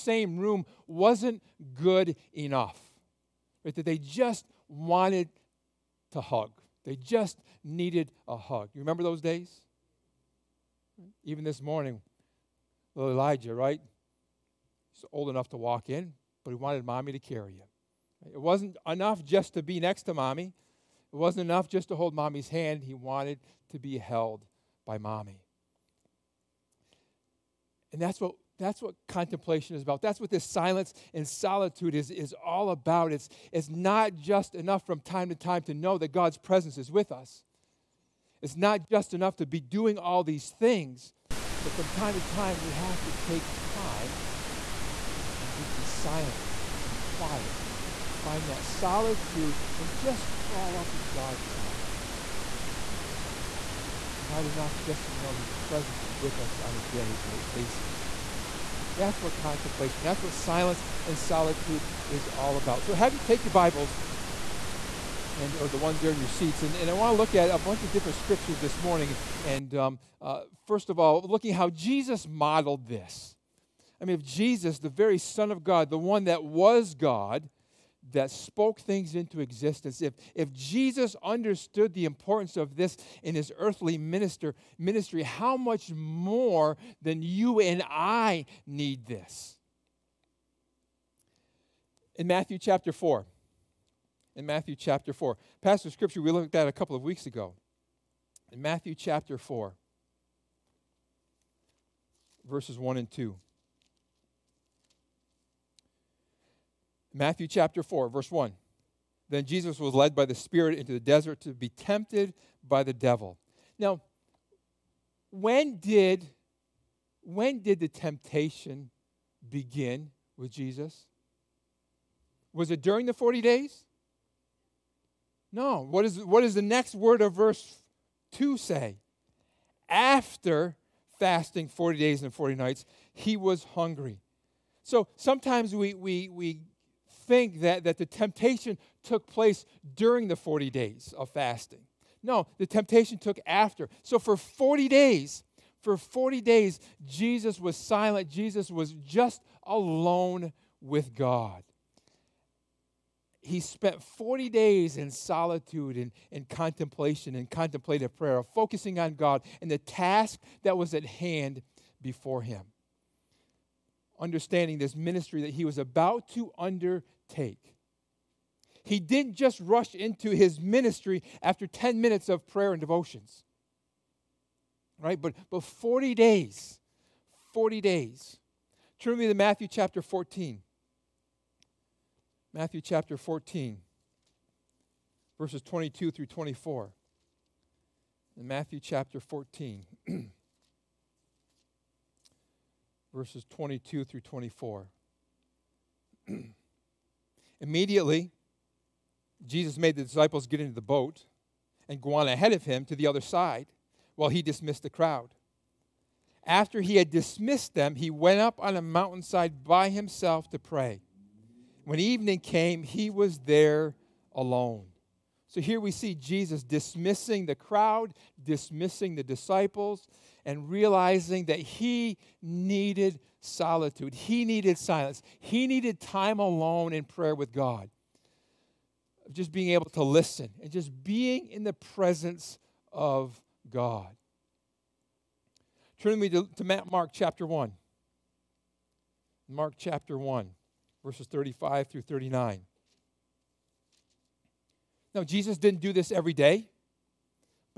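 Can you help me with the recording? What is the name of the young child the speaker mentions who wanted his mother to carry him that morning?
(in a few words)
Elijah.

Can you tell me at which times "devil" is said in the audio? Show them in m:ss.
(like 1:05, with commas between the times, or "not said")
1:52.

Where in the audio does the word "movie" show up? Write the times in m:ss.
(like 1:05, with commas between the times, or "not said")
not said.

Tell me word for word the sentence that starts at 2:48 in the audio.
He didn't just rush into his ministry after 10 minutes of prayer and devotions.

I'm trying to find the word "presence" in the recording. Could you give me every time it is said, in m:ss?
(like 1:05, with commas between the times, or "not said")
0:36, 0:55, 3:51.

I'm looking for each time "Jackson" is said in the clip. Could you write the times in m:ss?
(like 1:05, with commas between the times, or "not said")
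not said.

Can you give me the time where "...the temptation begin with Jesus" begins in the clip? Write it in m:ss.
1:57.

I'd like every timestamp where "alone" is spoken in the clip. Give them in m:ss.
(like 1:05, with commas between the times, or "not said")
2:29, 3:34, 3:46.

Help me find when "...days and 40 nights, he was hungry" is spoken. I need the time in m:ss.
2:11.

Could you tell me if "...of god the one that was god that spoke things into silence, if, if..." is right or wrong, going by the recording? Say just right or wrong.
wrong.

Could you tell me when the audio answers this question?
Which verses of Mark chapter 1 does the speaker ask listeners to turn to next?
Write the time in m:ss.
4:01.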